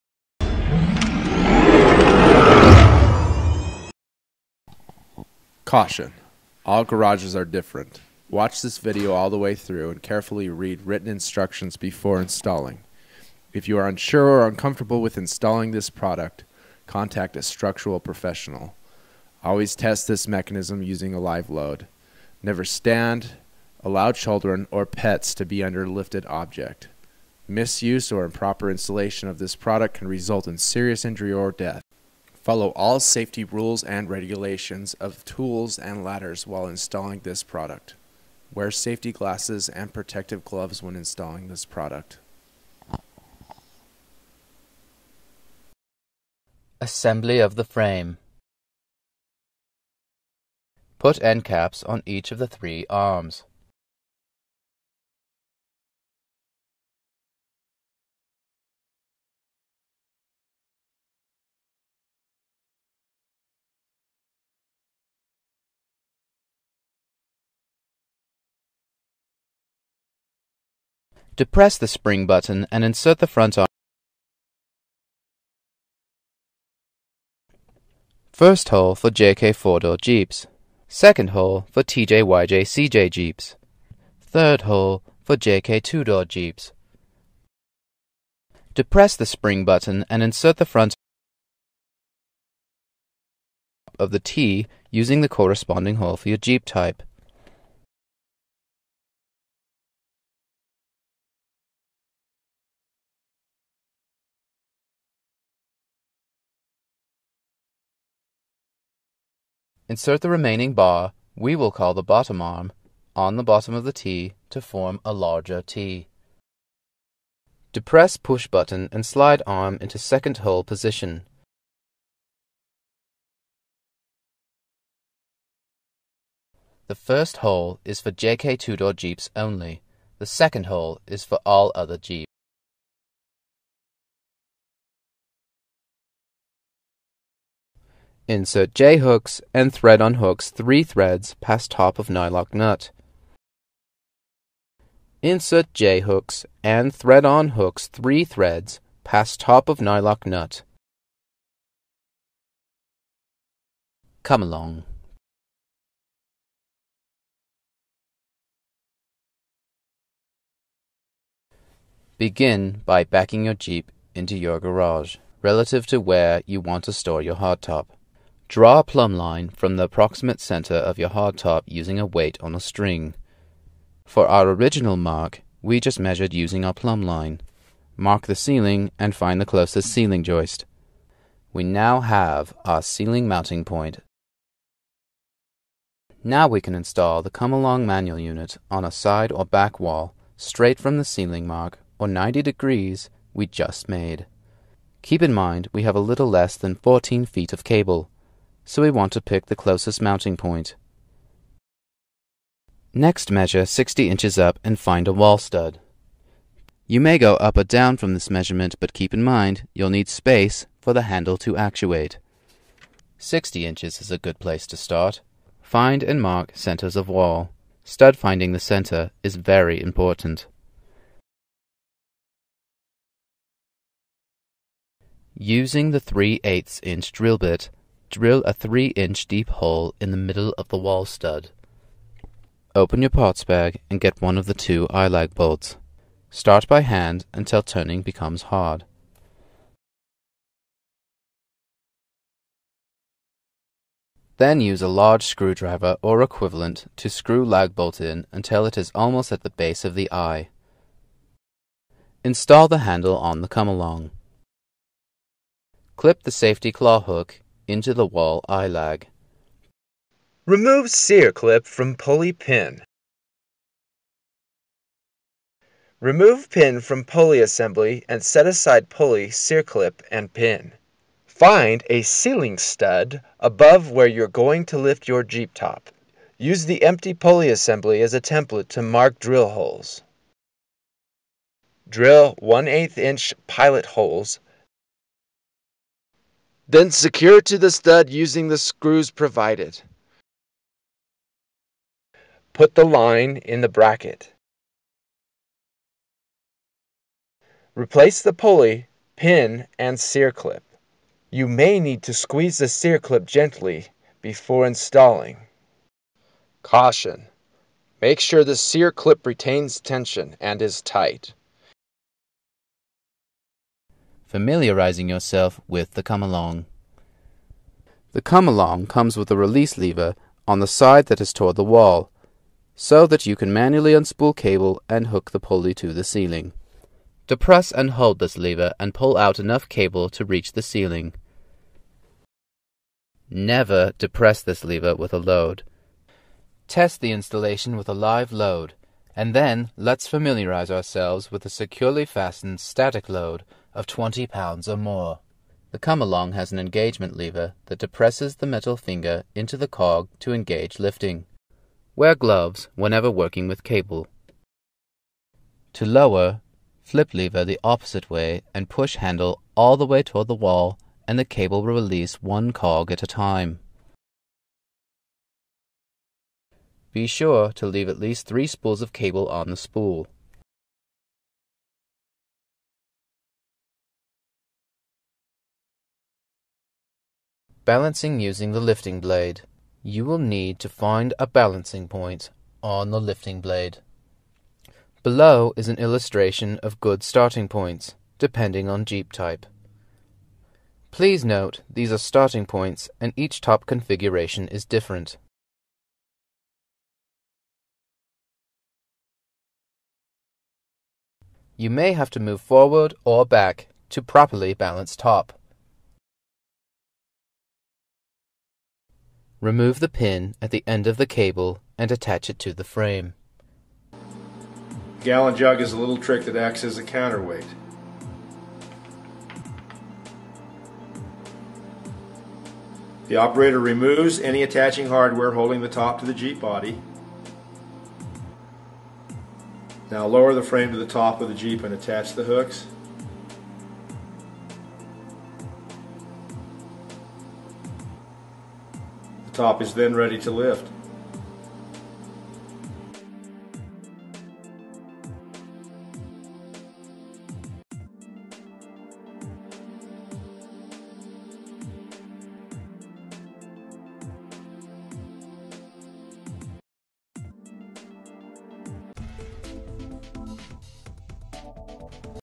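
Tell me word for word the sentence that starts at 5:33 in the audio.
Never depress this lever with a load.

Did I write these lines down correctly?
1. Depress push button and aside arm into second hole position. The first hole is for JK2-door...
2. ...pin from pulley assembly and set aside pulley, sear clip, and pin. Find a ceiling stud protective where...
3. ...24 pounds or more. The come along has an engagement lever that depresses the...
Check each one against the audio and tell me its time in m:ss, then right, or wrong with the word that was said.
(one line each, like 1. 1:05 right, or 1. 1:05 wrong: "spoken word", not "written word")
1. 1:57 wrong: "slide", not "aside"
2. 4:26 wrong: "above", not "protective"
3. 5:43 wrong: "20", not "24".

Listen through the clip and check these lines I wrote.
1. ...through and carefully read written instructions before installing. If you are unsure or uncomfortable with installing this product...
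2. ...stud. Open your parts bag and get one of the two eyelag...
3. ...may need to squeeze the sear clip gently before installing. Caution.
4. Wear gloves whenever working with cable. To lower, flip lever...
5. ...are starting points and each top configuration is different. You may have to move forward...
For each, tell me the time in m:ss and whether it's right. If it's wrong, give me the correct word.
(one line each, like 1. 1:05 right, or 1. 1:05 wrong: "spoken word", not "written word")
1. 0:09 right
2. 3:51 right
3. 5:01 right
4. 5:51 right
5. 6:31 right.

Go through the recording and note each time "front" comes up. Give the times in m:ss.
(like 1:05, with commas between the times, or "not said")
1:13, 1:30.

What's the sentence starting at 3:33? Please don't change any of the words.
60 inches is a good place to start.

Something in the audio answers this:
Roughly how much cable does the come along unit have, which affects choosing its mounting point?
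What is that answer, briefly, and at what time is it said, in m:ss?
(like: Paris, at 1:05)
A little less than 14 feet, at 3:15.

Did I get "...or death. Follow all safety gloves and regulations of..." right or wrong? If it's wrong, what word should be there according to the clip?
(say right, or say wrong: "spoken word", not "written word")
wrong: "rules", not "gloves".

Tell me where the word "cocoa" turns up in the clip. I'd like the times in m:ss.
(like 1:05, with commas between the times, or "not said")
not said.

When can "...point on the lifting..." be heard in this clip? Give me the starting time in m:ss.
6:21.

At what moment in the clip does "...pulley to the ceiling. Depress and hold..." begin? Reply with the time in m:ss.
5:25.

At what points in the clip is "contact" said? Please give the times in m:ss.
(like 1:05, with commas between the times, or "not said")
0:16.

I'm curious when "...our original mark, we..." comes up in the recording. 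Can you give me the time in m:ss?
2:54.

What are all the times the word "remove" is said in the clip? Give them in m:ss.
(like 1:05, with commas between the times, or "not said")
4:20, 4:26, 6:49, 7:03.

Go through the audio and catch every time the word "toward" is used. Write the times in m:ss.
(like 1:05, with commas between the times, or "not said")
5:21, 6:00.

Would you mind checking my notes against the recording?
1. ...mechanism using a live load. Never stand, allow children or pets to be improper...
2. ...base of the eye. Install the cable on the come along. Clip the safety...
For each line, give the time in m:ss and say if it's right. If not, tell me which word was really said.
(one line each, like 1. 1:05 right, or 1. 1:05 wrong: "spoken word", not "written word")
1. 0:20 wrong: "under", not "improper"
2. 4:09 wrong: "handle", not "cable".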